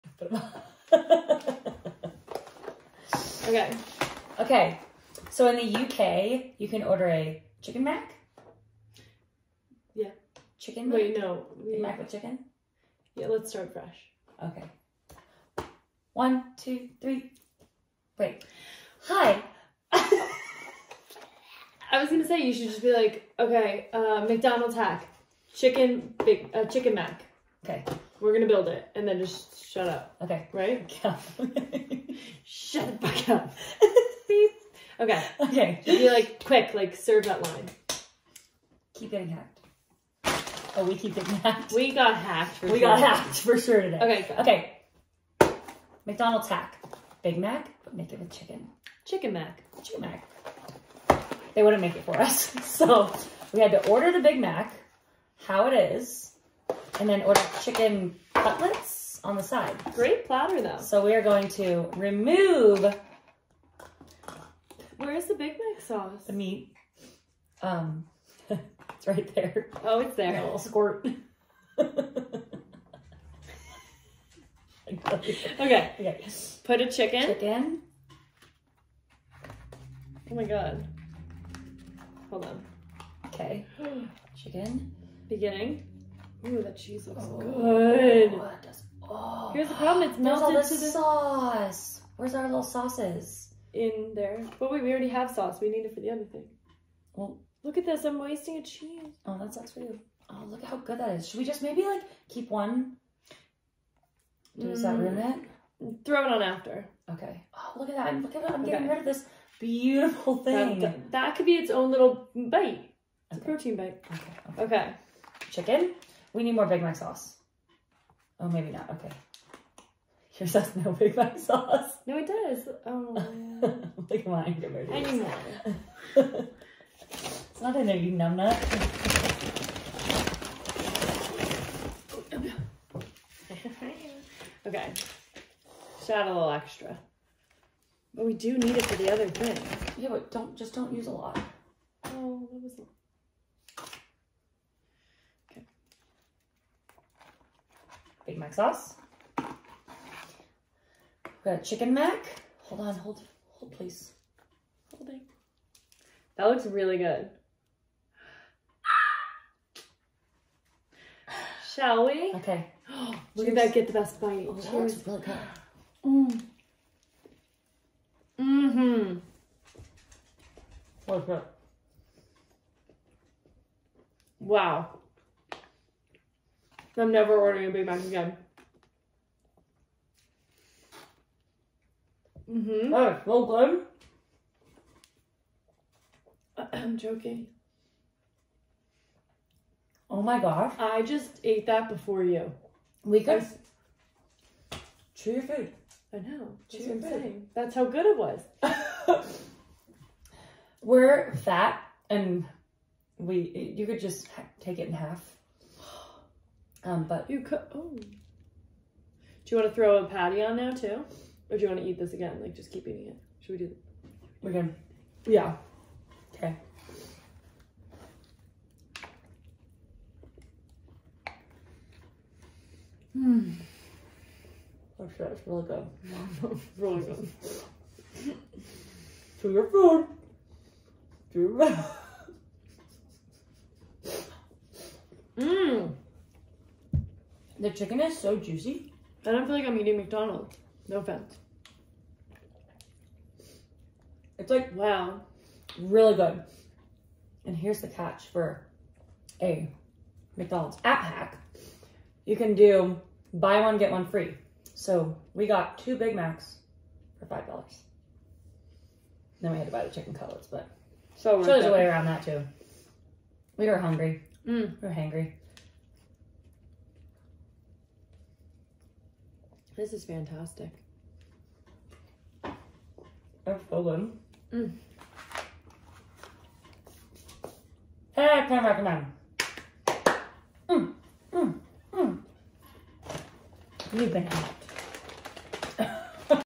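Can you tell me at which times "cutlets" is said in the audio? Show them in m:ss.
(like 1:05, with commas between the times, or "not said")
0:58, 4:20.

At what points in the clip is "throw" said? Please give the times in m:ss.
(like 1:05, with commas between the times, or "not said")
1:46, 3:29.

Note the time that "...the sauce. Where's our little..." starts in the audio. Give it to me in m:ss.
1:30.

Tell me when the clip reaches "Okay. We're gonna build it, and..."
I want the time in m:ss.
0:27.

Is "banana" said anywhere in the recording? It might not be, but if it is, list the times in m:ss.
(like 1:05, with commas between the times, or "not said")
4:44.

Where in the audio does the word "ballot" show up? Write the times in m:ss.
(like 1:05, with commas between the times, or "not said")
not said.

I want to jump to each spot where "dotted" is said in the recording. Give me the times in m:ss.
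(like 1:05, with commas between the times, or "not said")
not said.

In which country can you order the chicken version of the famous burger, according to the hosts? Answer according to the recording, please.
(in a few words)
UK.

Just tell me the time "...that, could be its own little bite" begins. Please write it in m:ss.
1:51.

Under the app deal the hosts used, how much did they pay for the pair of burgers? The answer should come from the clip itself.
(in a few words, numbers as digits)
$5.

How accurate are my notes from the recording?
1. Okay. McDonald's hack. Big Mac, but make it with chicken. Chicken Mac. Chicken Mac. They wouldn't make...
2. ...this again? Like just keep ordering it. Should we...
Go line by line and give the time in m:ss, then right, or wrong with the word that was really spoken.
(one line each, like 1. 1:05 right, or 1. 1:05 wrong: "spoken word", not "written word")
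1. 0:45 right
2. 3:31 wrong: "eating", not "ordering".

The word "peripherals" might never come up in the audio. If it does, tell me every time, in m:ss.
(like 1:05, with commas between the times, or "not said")
not said.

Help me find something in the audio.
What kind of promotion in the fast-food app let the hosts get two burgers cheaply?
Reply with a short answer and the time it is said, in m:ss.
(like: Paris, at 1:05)
buy one, get one free, at 4:13.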